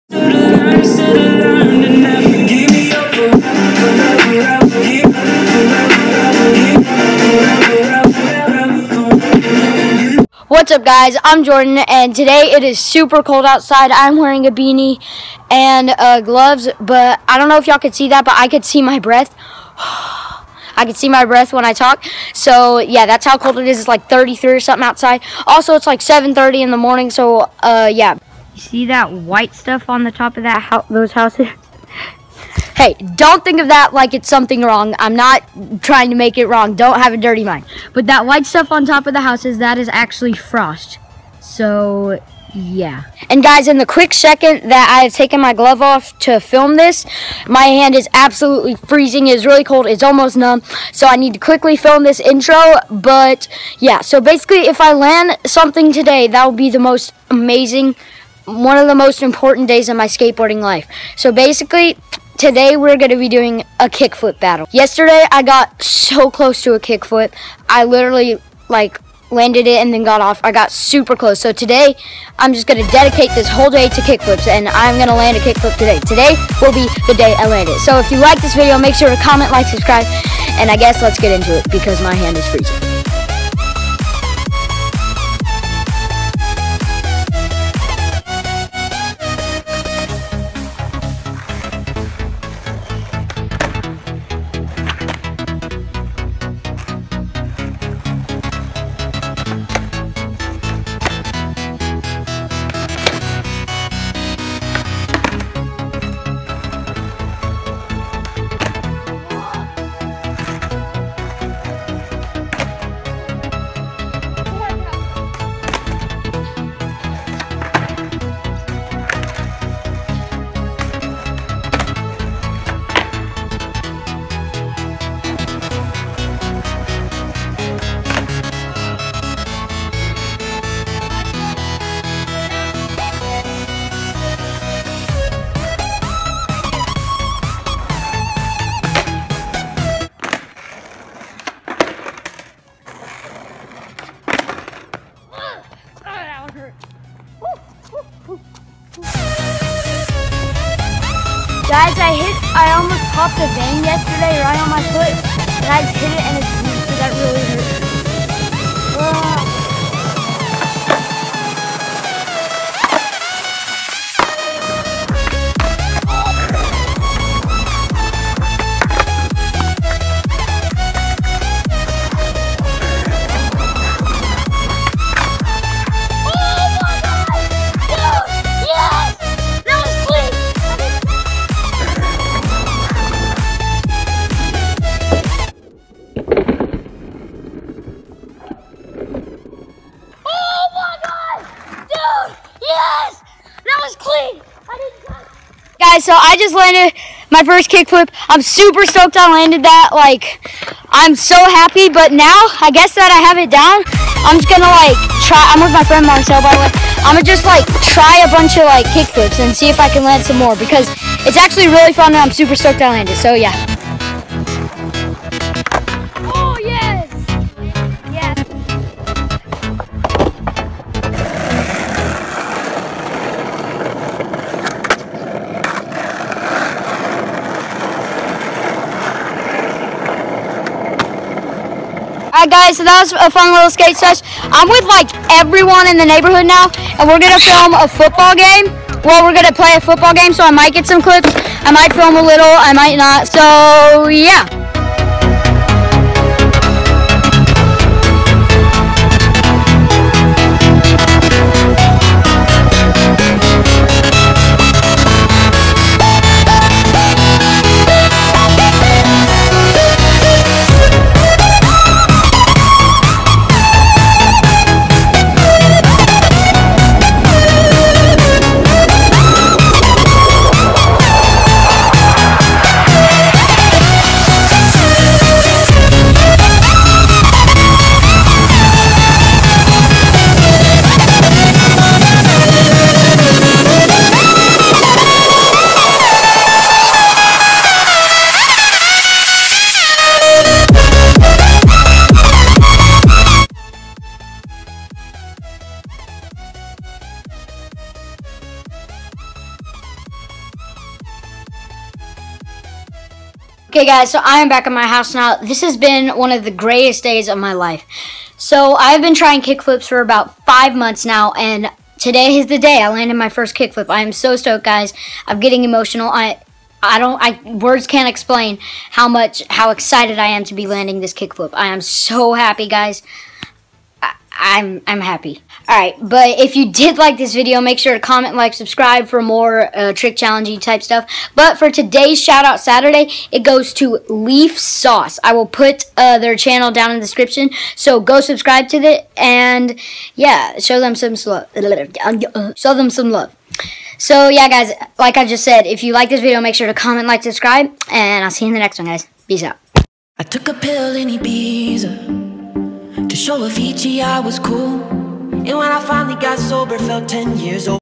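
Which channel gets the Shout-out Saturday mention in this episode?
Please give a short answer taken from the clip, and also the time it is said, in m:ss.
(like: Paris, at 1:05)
Leaf Sauce, at 5:34.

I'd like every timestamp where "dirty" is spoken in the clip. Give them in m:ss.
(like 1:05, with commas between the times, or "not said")
0:37.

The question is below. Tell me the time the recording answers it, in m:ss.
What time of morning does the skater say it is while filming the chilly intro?
0:25.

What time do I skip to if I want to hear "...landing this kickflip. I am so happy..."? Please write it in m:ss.
5:20.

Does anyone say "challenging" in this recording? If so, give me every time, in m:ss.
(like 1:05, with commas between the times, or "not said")
5:30.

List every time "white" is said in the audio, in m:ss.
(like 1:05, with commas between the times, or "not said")
0:29, 0:38.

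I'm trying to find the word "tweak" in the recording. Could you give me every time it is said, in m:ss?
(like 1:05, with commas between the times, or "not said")
not said.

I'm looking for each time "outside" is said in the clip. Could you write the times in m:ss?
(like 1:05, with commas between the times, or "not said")
0:13, 0:24.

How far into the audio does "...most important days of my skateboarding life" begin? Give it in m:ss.
0:58.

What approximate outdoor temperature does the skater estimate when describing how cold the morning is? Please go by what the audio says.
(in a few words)
33.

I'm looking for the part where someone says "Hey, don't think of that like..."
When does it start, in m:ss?
0:32.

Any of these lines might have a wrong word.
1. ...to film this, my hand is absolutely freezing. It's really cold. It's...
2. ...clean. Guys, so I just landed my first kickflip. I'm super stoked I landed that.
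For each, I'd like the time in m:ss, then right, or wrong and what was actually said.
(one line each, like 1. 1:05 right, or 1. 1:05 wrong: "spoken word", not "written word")
1. 0:46 right
2. 3:14 right.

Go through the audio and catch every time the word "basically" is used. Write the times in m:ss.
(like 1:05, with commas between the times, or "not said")
0:54, 1:01.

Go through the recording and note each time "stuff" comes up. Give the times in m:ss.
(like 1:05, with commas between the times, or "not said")
0:29, 0:38, 5:30.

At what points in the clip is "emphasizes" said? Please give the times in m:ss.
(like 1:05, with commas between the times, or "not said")
not said.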